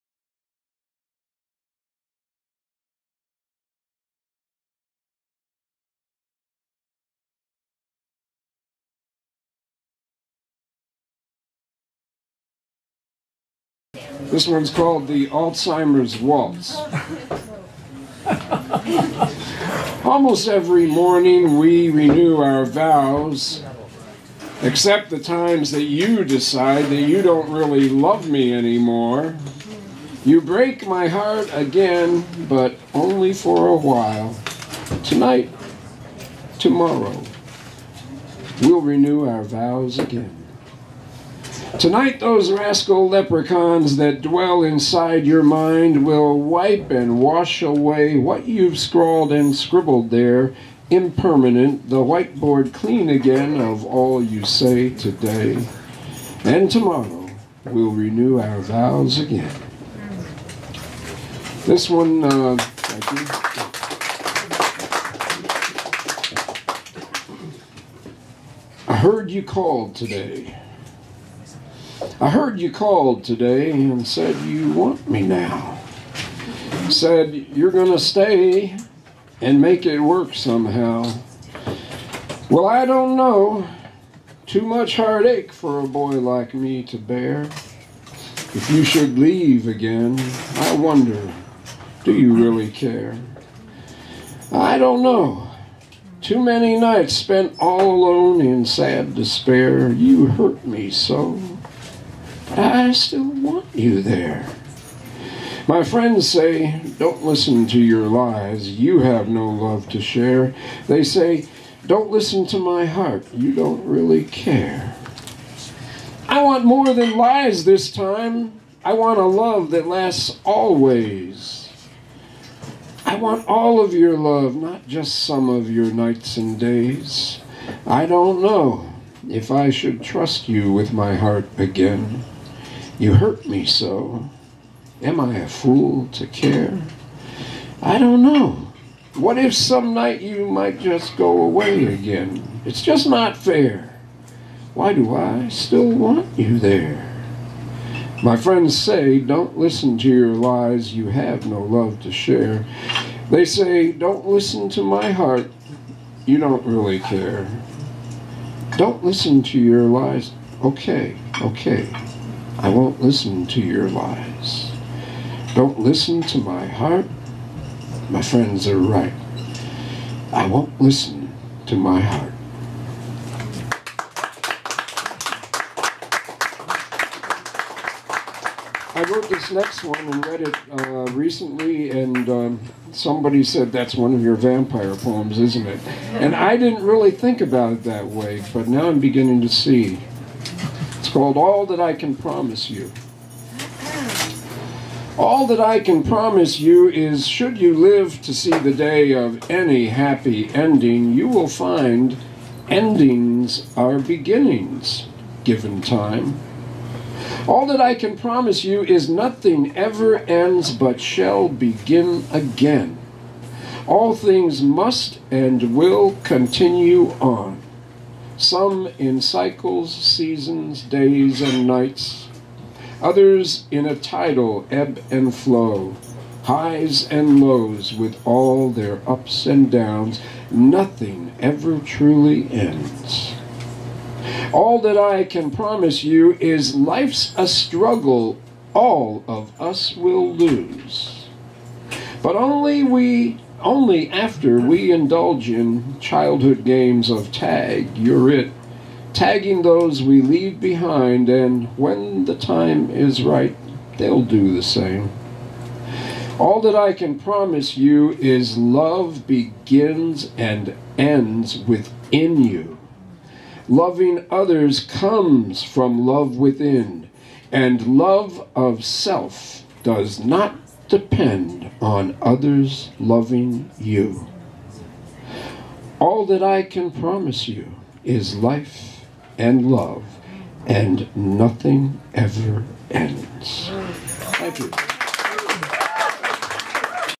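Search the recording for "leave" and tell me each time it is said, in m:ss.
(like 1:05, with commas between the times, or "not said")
1:29, 4:10.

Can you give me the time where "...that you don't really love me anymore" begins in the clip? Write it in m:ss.
0:26.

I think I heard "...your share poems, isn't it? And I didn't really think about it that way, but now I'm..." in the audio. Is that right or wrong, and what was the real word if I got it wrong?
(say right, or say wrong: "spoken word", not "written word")
wrong: "vampire", not "share".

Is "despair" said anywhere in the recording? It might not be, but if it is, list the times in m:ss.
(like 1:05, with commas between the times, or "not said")
1:39.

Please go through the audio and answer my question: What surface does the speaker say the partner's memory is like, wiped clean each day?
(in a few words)
whiteboard.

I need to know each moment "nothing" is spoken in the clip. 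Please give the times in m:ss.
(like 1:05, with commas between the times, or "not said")
3:29, 3:50, 4:41.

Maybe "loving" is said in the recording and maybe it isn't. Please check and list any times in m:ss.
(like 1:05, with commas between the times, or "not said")
4:23, 4:32.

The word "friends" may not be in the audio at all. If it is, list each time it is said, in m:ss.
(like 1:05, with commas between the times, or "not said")
1:45, 2:28, 2:48.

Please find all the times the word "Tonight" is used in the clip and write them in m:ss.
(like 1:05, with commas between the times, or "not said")
0:35, 0:41.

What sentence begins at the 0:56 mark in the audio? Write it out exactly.
And tomorrow, we'll renew our vows again.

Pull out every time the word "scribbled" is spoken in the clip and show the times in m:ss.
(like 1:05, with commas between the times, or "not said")
0:49.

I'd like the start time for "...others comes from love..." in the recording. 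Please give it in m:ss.
4:24.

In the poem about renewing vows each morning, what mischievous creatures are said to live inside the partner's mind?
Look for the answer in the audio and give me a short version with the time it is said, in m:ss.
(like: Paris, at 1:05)
leprechauns, at 0:42.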